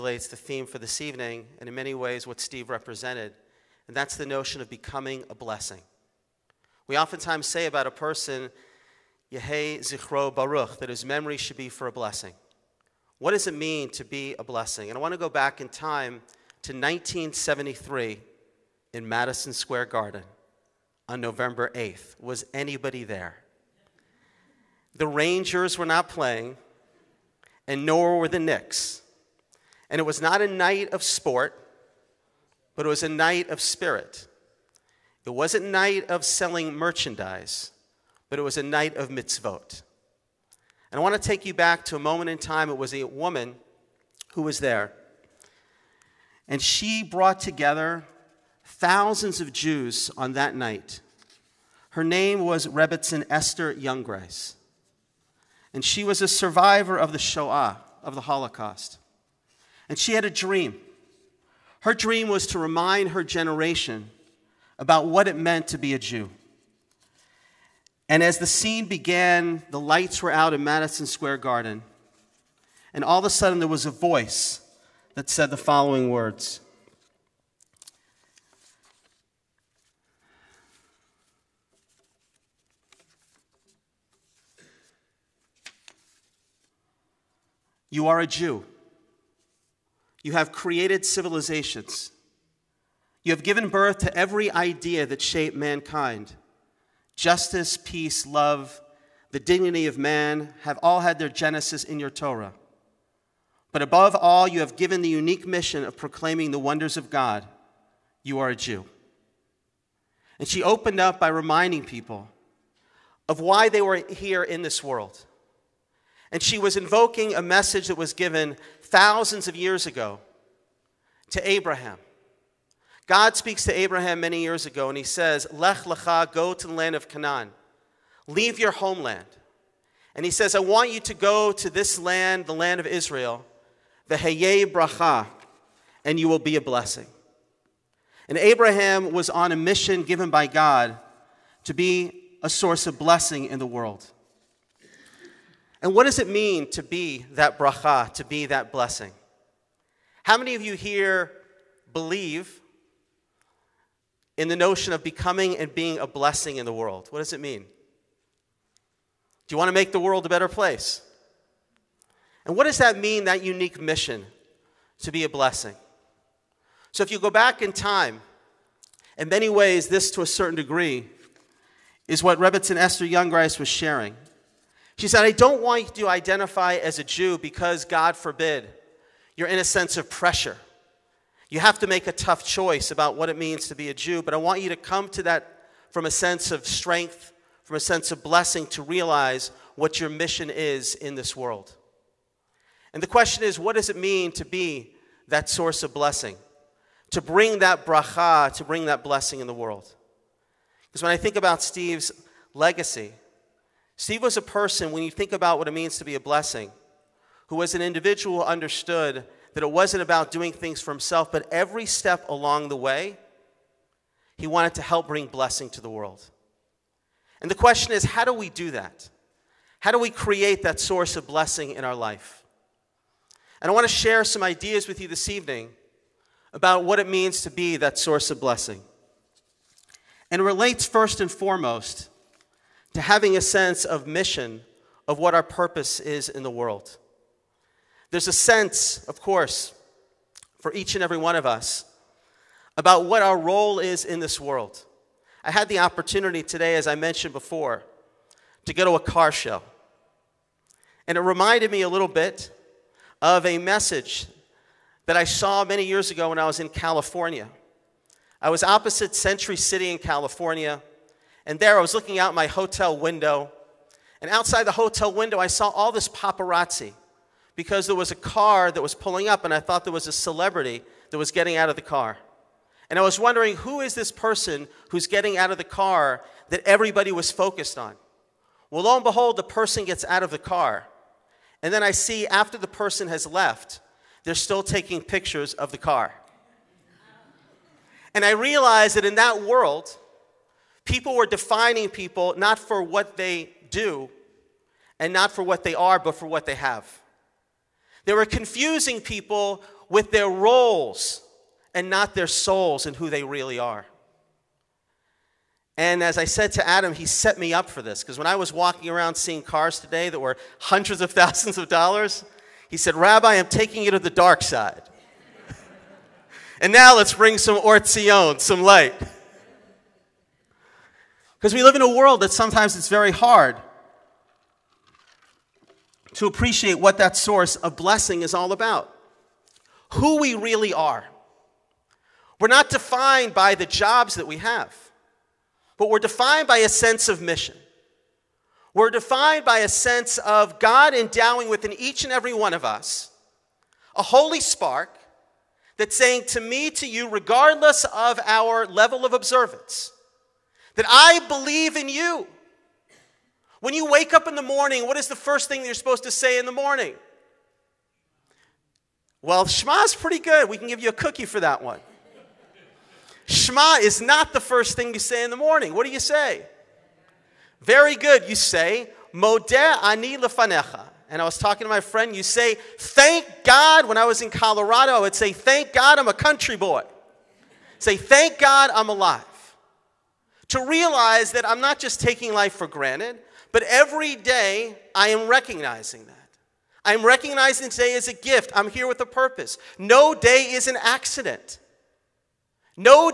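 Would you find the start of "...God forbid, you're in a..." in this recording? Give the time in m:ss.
2:57.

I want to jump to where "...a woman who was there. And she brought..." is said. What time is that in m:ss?
0:42.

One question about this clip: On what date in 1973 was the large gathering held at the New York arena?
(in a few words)
November 8.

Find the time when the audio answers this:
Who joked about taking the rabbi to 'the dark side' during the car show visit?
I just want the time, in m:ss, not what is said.
5:06.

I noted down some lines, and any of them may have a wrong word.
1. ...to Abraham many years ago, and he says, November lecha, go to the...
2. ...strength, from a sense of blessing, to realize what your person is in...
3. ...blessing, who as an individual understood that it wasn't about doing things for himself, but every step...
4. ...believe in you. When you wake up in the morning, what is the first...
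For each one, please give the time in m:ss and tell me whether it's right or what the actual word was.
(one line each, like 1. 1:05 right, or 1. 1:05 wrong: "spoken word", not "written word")
1. 2:03 wrong: "Lech", not "November"
2. 3:06 wrong: "mission", not "person"
3. 3:26 right
4. 5:51 right.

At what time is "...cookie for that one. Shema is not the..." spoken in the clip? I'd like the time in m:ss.
6:00.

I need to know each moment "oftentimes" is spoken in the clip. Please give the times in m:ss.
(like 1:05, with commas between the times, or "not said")
0:06.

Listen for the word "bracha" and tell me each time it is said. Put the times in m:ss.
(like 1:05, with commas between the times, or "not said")
2:14, 2:27, 3:17.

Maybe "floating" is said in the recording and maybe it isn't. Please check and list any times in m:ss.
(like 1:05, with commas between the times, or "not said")
not said.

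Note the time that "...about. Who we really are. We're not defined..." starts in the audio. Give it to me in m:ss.
5:28.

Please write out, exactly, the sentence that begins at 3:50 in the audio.
And it relates first and foremost to having a sense of mission, of what our purpose is in the world.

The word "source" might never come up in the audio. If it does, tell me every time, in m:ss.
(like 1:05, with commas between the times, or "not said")
2:22, 3:15, 3:40, 3:47, 5:27.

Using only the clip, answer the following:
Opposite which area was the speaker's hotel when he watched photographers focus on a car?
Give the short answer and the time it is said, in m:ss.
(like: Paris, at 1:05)
Century City, at 4:19.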